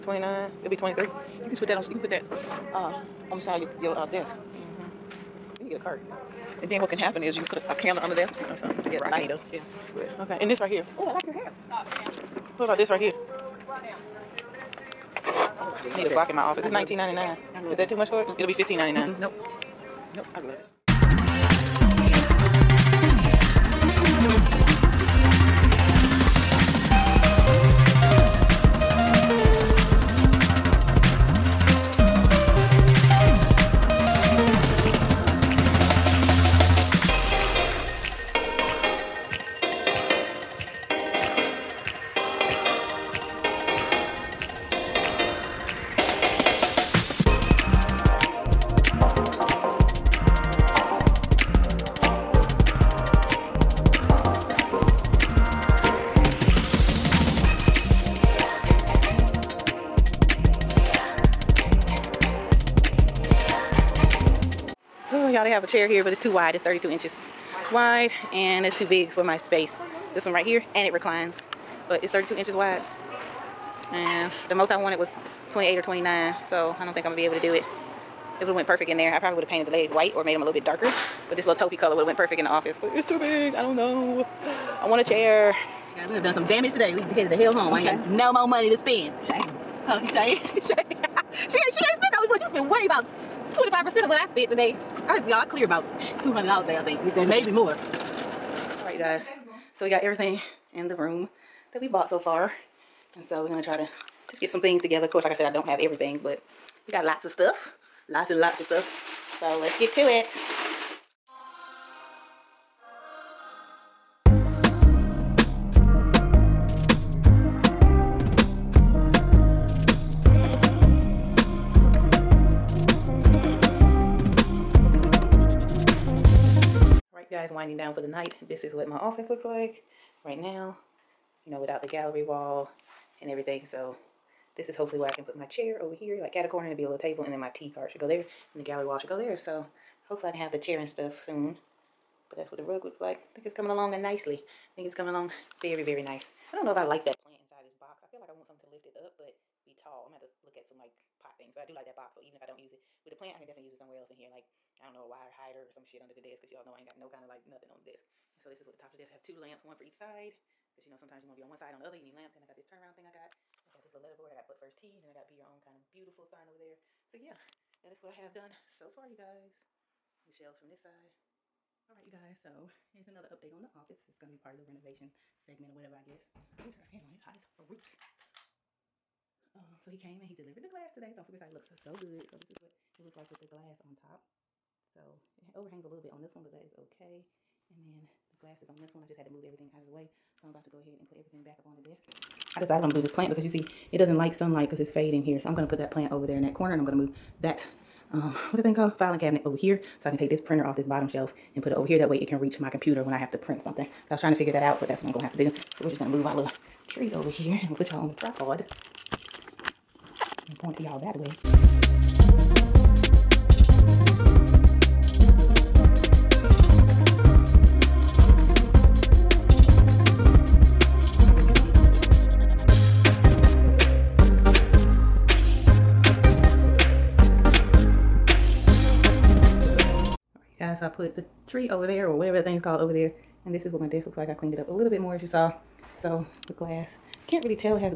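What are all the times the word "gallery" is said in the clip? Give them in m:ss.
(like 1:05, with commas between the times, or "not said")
2:11, 2:18.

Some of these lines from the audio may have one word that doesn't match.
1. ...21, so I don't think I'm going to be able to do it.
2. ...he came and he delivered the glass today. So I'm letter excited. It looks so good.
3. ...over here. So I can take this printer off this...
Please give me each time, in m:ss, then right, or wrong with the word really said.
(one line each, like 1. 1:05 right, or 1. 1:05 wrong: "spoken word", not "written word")
1. 1:15 wrong: "29", not "21"
2. 2:59 wrong: "super", not "letter"
3. 3:19 right.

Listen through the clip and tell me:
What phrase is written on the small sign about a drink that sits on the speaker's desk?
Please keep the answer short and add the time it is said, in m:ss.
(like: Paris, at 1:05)
But First Tea, at 2:44.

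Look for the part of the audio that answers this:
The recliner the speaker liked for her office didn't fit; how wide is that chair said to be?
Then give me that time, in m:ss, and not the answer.
1:06.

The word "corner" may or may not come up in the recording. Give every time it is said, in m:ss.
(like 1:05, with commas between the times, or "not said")
2:16, 3:16.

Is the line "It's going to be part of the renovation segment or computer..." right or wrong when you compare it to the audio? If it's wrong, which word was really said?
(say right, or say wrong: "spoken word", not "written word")
wrong: "whatever", not "computer".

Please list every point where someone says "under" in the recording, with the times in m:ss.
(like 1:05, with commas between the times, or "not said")
0:08, 2:36.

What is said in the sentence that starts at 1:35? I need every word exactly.
I y'all clear about two hundred dollars a day, I think.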